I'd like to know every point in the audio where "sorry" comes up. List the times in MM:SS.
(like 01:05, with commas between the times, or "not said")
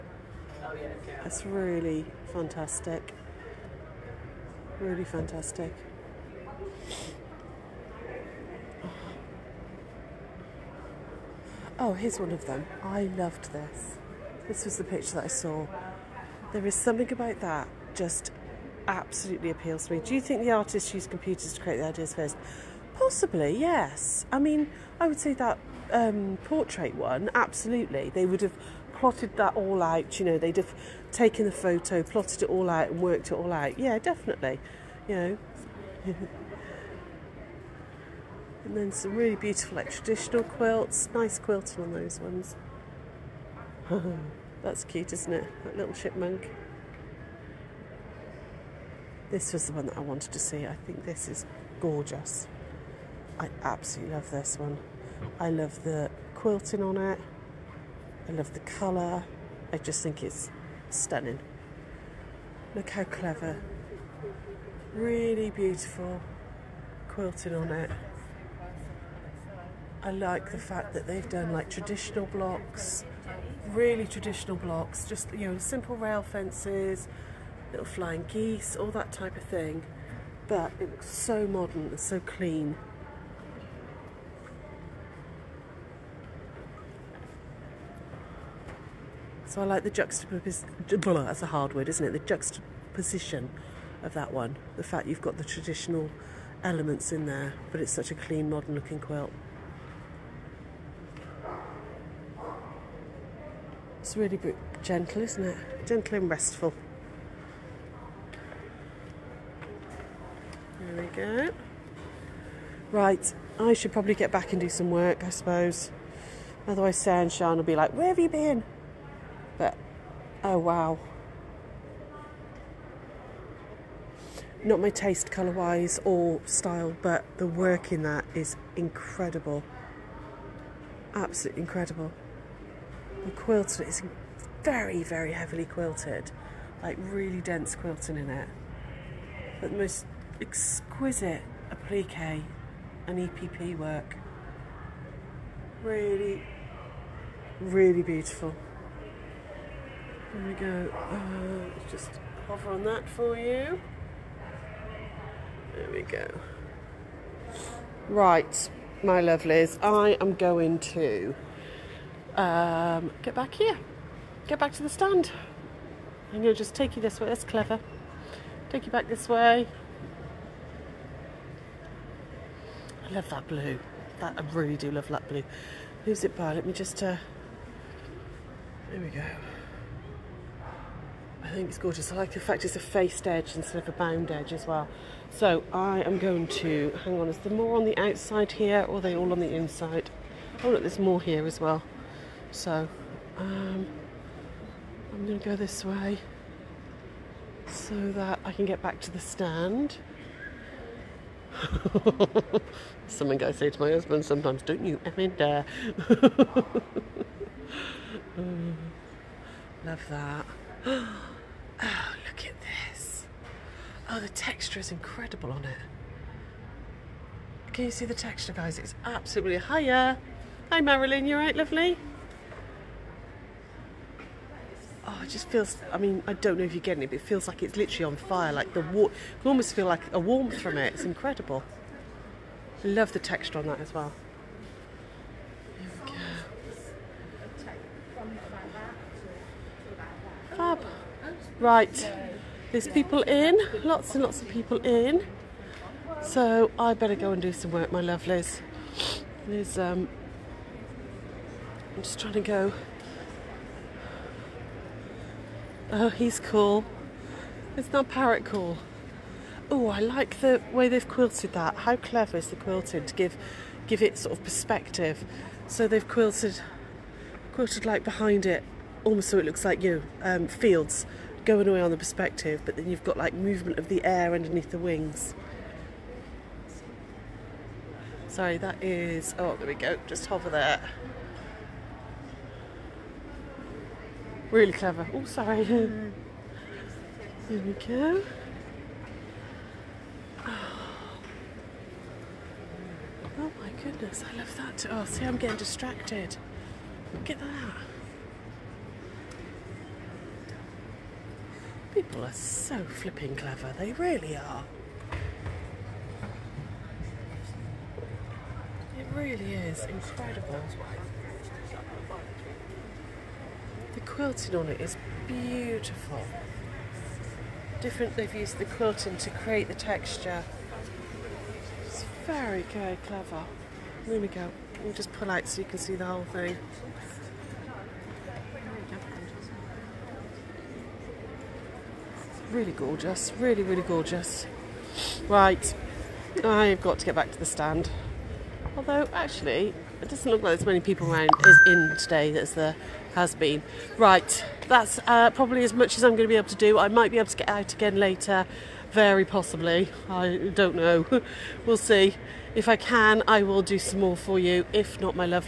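04:38, 04:45.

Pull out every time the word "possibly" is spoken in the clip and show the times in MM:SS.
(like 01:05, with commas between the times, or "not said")
00:22, 05:49.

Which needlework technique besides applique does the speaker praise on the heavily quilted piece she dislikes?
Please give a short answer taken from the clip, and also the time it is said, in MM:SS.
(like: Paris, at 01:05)
EPP, at 02:23.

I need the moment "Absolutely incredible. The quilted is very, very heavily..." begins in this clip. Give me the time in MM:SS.
02:11.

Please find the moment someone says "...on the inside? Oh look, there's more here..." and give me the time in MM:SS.
03:09.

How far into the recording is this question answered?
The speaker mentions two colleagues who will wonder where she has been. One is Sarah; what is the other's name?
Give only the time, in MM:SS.
01:57.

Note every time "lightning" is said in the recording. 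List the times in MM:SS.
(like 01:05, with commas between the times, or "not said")
not said.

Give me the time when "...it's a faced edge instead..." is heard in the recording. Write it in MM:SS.
03:02.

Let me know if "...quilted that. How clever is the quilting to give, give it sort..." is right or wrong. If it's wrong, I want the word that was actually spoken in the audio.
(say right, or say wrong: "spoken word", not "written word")
right.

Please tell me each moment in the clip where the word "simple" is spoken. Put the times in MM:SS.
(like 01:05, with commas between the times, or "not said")
01:15.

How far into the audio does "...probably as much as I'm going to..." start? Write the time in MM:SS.
05:45.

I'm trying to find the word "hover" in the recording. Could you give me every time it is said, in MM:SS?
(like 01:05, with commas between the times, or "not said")
02:32, 04:40.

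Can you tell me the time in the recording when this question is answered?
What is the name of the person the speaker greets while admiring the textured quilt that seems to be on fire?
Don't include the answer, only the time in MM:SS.
03:40.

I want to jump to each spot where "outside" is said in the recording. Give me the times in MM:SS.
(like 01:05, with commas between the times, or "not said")
03:07.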